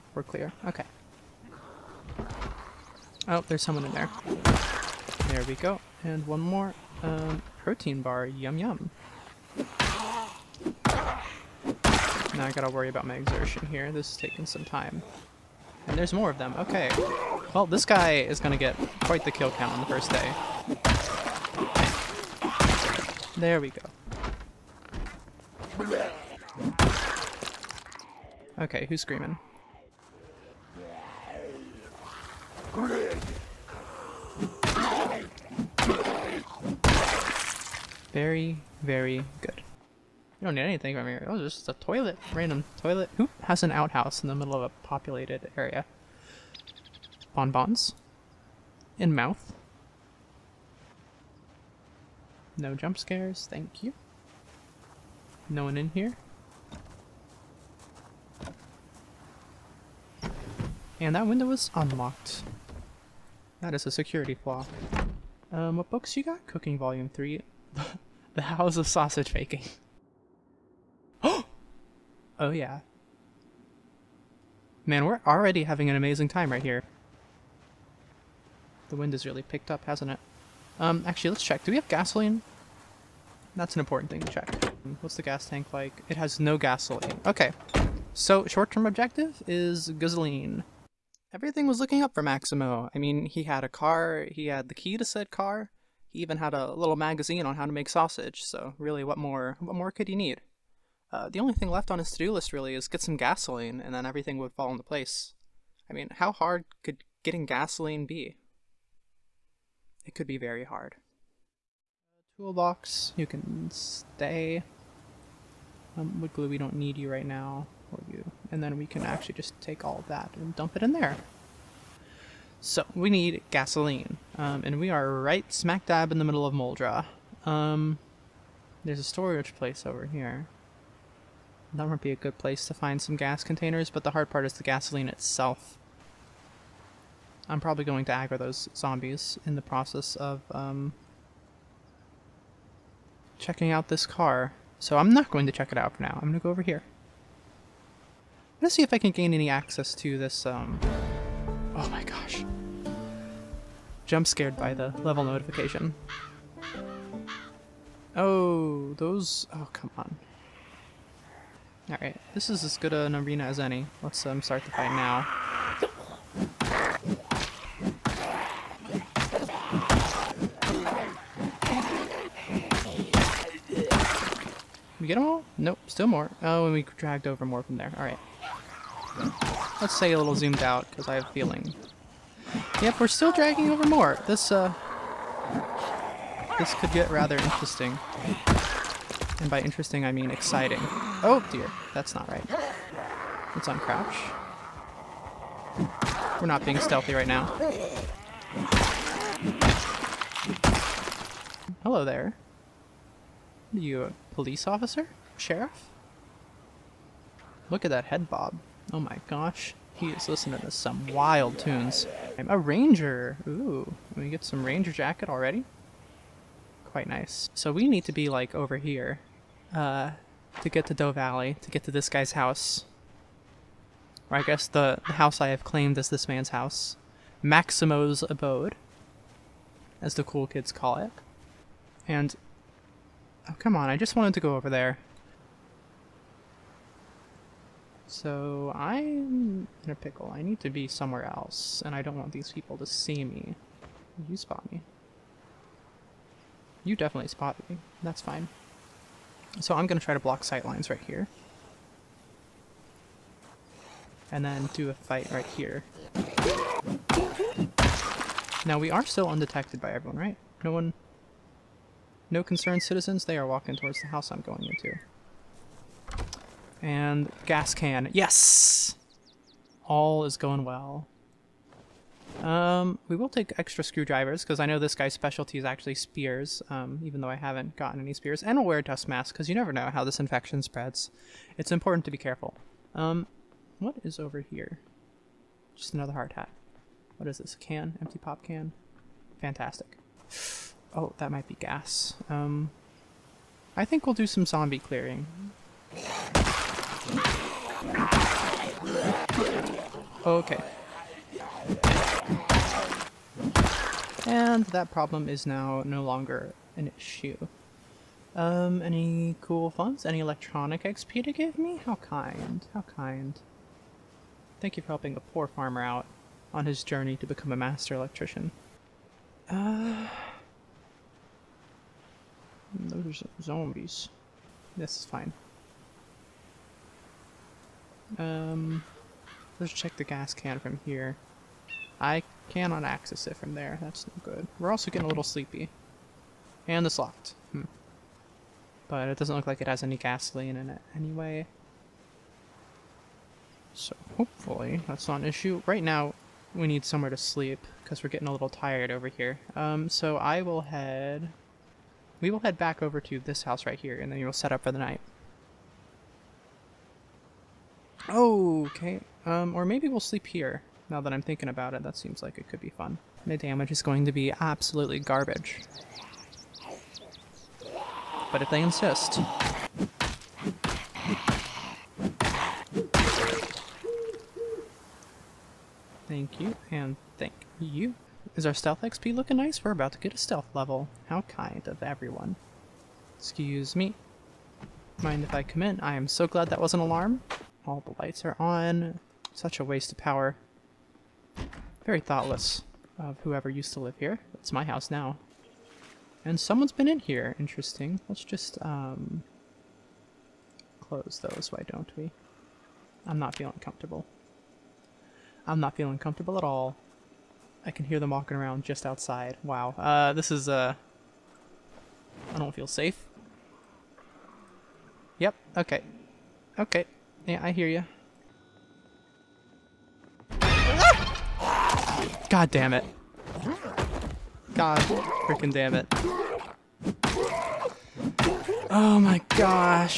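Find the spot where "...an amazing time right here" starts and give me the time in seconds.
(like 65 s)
75 s.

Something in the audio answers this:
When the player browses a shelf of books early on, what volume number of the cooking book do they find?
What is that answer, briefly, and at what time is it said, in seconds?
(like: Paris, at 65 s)
3, at 66 s.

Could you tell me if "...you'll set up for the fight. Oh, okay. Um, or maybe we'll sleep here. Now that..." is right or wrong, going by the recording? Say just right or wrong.
wrong.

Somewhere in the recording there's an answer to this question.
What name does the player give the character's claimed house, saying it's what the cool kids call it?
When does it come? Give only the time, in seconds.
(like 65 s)
227 s.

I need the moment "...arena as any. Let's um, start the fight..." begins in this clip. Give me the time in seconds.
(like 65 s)
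163 s.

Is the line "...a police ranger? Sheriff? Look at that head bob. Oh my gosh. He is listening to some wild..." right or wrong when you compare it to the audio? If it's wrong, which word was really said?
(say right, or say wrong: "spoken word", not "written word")
wrong: "officer", not "ranger".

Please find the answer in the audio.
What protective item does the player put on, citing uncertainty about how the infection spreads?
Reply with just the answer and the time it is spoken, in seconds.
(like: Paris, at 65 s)
Dust mask, at 278 s.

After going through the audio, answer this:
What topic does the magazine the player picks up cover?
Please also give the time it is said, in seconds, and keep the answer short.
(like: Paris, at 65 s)
Sausage making, at 68 s.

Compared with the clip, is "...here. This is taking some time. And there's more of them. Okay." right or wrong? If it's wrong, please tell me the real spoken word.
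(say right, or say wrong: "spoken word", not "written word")
right.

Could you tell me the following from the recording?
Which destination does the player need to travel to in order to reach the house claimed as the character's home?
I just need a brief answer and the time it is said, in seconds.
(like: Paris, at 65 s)
Doe Valley, at 220 s.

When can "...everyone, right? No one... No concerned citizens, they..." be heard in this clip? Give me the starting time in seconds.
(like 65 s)
259 s.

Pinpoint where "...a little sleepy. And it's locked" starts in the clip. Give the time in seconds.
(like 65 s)
335 s.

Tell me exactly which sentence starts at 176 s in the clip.
Oh, and we dragged over more from there.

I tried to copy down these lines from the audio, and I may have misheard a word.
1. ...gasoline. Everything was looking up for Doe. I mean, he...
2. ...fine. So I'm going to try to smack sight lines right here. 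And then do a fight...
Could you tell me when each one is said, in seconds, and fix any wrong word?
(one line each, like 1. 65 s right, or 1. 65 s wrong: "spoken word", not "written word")
1. 89 s wrong: "Maximo", not "Doe"
2. 248 s wrong: "block", not "smack".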